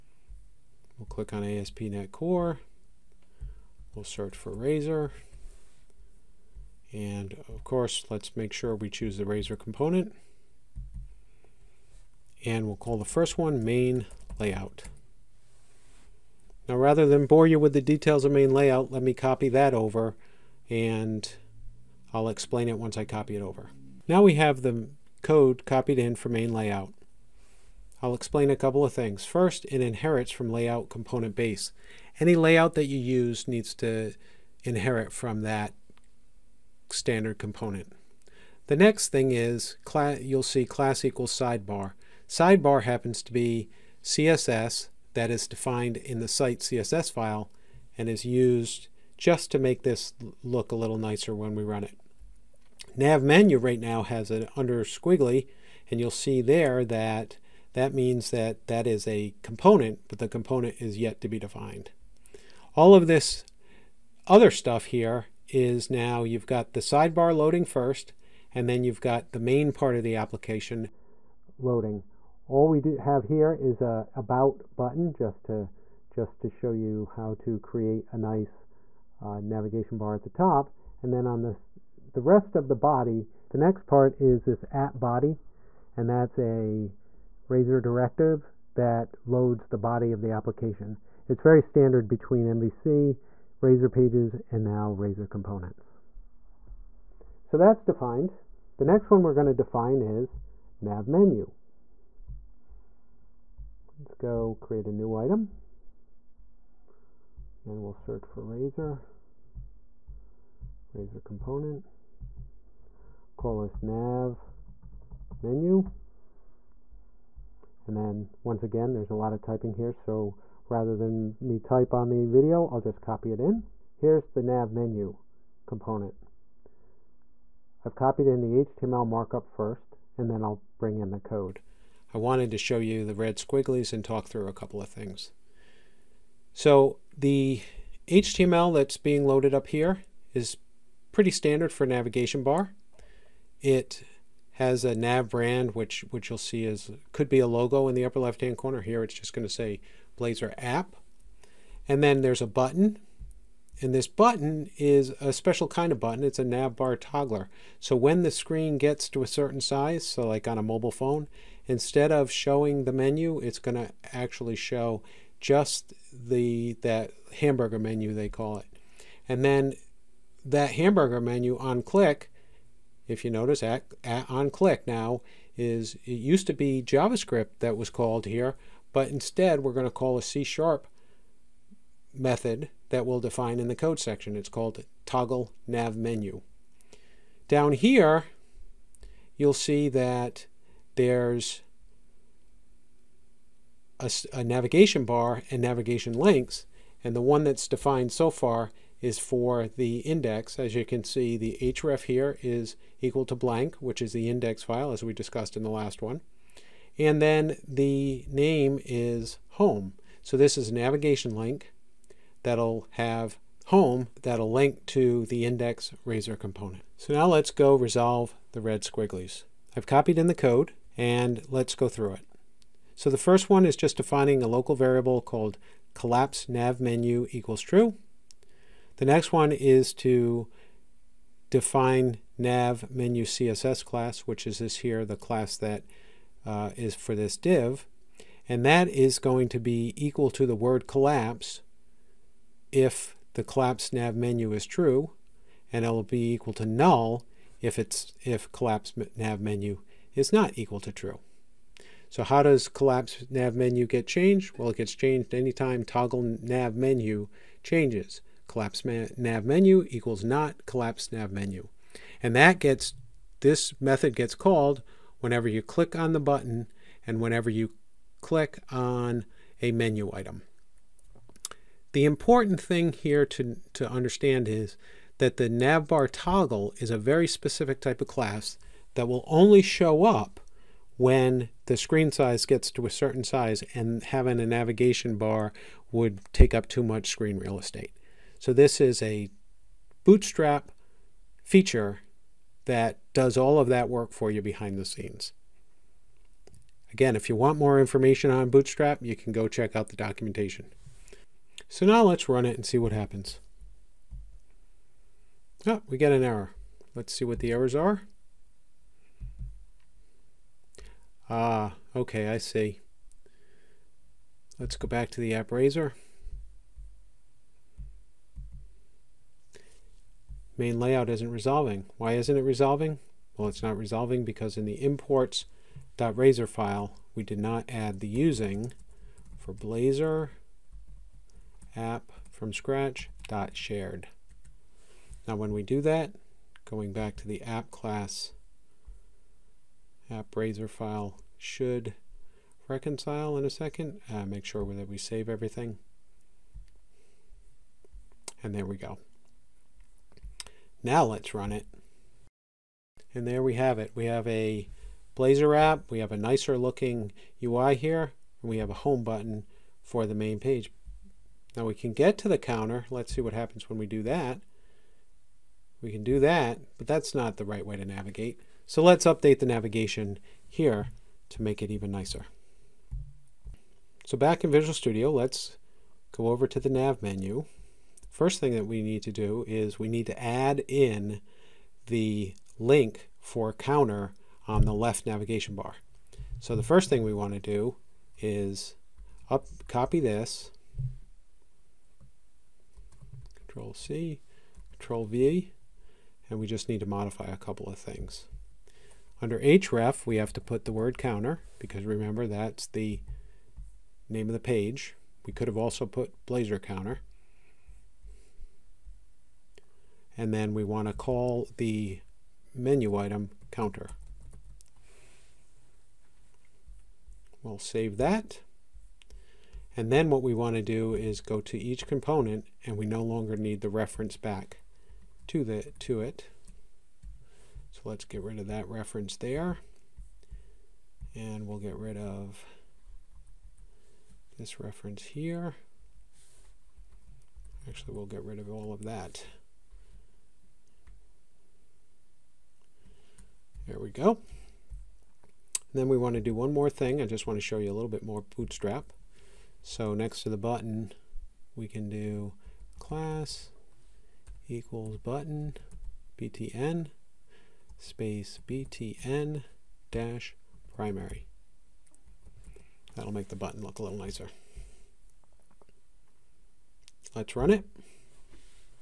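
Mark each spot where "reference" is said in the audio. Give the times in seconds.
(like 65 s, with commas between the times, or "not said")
423 s, 428 s, 434 s.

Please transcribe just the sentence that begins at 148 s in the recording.
Here it's just going to say Blazor app.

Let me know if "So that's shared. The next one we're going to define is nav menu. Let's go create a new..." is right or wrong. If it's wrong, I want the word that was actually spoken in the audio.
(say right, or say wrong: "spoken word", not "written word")
wrong: "defined", not "shared".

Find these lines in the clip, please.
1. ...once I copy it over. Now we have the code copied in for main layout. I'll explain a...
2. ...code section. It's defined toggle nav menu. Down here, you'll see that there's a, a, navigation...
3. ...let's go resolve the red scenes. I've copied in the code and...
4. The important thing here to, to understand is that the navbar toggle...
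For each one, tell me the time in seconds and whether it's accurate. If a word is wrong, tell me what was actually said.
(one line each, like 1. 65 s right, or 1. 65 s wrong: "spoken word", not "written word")
1. 22 s right
2. 183 s wrong: "called", not "defined"
3. 217 s wrong: "squigglies", not "scenes"
4. 271 s right.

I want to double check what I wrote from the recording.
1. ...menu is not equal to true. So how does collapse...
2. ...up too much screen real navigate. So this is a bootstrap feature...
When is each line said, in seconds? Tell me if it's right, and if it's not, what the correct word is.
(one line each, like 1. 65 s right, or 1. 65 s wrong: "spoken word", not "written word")
1. 249 s right
2. 286 s wrong: "estate", not "navigate".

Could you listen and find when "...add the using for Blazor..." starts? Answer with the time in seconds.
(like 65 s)
327 s.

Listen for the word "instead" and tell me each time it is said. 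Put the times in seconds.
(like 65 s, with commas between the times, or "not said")
161 s, 179 s.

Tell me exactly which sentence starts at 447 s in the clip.
I just want to show you a little bit more Bootstrap.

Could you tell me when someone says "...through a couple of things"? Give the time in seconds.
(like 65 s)
134 s.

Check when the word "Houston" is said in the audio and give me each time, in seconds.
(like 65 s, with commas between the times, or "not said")
not said.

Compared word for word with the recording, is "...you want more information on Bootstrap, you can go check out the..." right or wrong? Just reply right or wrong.
right.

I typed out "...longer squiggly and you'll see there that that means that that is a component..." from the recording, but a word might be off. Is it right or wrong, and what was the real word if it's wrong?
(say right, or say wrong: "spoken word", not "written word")
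wrong: "under", not "longer".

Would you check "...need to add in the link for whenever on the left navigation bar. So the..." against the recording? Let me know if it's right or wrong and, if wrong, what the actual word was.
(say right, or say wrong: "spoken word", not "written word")
wrong: "counter", not "whenever".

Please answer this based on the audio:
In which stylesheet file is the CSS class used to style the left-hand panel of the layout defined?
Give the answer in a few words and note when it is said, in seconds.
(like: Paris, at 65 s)
site CSS, at 46 s.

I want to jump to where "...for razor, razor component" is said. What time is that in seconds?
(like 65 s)
108 s.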